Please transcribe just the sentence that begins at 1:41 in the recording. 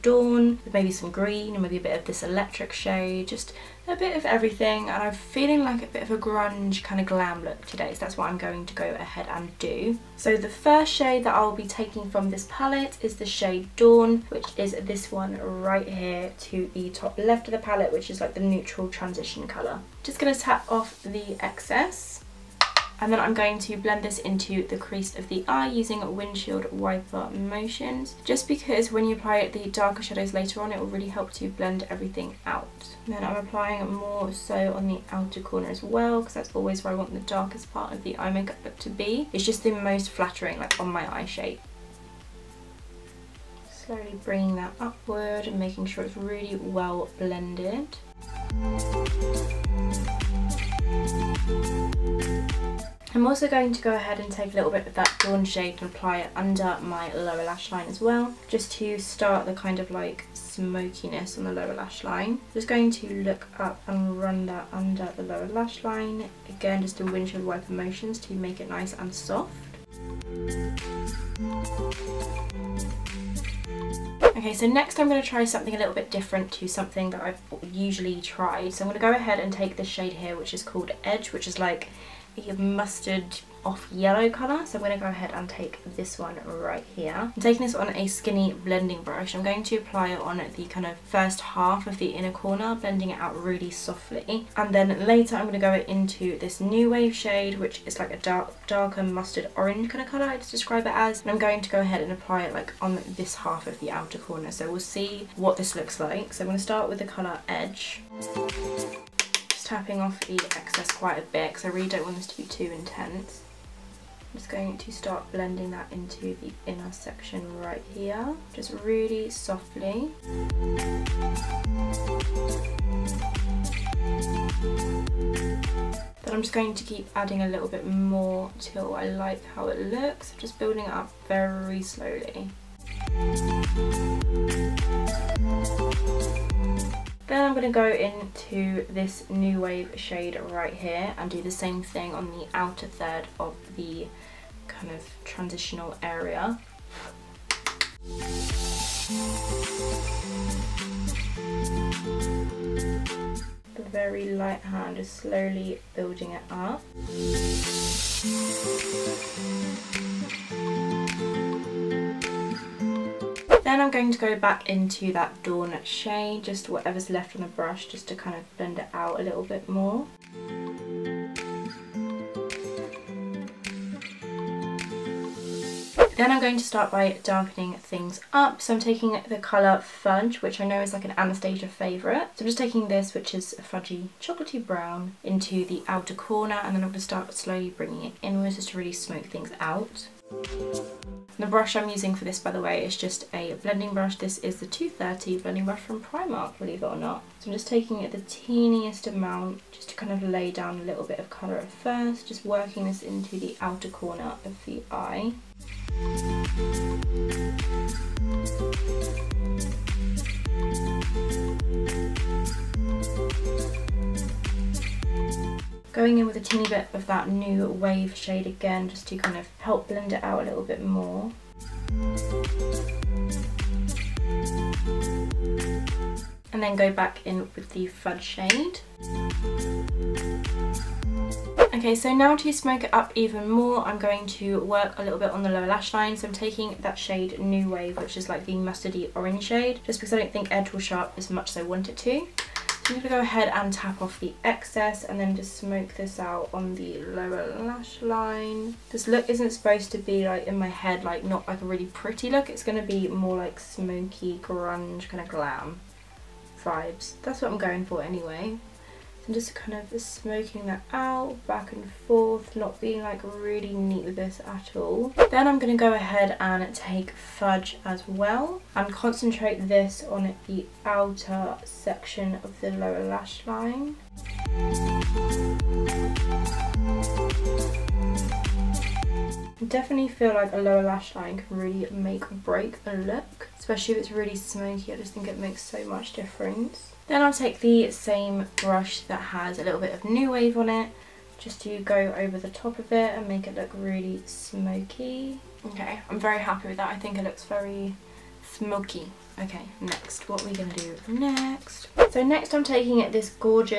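And I'm going to go ahead and apply it like on this half of the outer corner.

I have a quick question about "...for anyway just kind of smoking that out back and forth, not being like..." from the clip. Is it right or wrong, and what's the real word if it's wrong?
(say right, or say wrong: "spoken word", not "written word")
right.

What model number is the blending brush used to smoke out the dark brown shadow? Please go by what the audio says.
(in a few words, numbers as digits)
230.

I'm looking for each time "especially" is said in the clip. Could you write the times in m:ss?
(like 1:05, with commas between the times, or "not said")
4:43.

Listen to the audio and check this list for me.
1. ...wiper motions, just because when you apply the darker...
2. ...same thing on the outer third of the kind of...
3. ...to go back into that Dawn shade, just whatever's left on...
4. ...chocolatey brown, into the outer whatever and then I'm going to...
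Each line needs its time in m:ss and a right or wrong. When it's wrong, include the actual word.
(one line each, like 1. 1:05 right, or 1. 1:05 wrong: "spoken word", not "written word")
1. 0:26 right
2. 2:21 right
3. 2:44 right
4. 3:04 wrong: "corner", not "whatever".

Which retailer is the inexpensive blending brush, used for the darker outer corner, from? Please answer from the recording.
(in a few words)
Primark.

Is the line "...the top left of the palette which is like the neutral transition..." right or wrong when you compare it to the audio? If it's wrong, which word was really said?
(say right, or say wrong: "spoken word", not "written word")
right.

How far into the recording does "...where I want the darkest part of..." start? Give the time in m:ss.
0:36.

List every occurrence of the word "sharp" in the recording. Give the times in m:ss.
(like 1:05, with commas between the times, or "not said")
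4:00.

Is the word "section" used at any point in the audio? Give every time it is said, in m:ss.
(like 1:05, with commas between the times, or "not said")
1:56, 4:31.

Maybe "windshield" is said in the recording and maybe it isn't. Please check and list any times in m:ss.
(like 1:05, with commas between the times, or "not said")
0:26, 1:07.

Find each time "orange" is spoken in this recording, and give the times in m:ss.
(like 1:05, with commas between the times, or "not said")
1:39, 3:59.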